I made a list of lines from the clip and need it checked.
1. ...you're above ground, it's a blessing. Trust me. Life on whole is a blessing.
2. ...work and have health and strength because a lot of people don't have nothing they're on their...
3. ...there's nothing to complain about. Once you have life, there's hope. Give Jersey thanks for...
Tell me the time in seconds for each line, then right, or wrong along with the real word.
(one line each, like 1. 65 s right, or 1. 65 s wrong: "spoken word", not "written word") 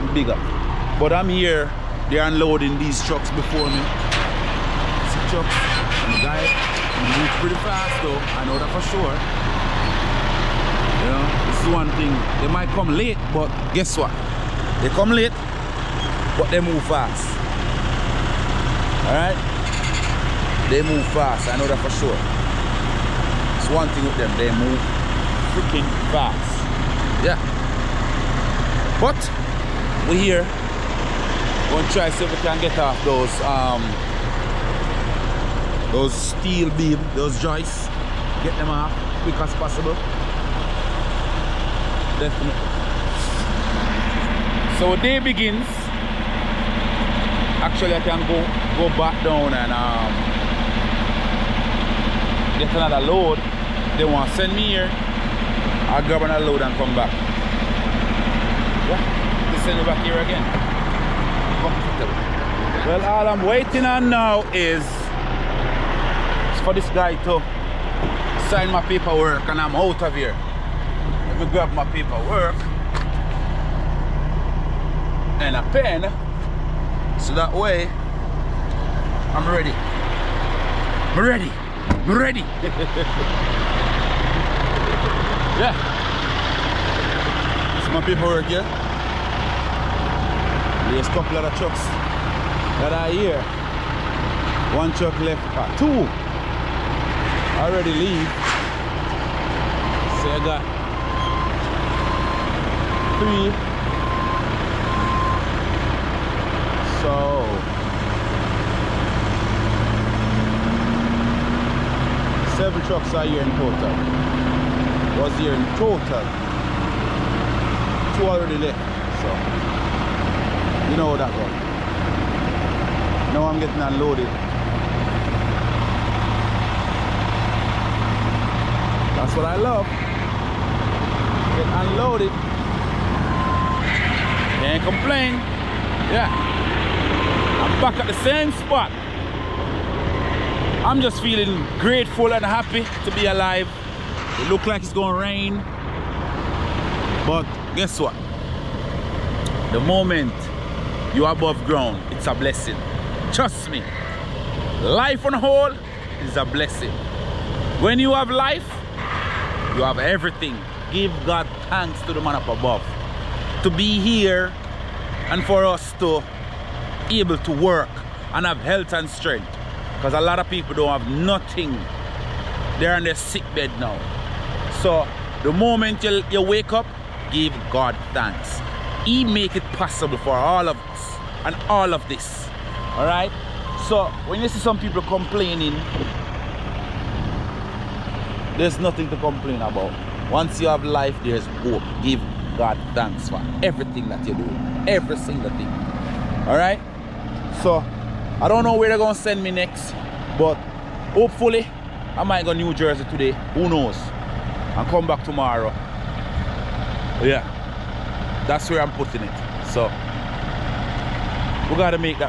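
1. 151 s right
2. 167 s right
3. 188 s wrong: "God", not "Jersey".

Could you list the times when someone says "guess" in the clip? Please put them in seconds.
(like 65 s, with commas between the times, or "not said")
13 s, 147 s.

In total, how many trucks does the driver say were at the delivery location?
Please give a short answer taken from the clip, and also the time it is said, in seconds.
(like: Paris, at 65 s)
7, at 112 s.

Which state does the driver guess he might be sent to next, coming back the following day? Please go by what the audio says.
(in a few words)
New Jersey.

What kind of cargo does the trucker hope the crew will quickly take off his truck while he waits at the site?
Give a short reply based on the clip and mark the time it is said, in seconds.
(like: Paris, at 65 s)
Steel beams, at 36 s.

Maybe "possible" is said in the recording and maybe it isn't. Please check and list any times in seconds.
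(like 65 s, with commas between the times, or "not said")
39 s, 179 s.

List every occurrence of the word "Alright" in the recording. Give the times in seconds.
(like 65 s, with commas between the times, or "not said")
19 s, 196 s.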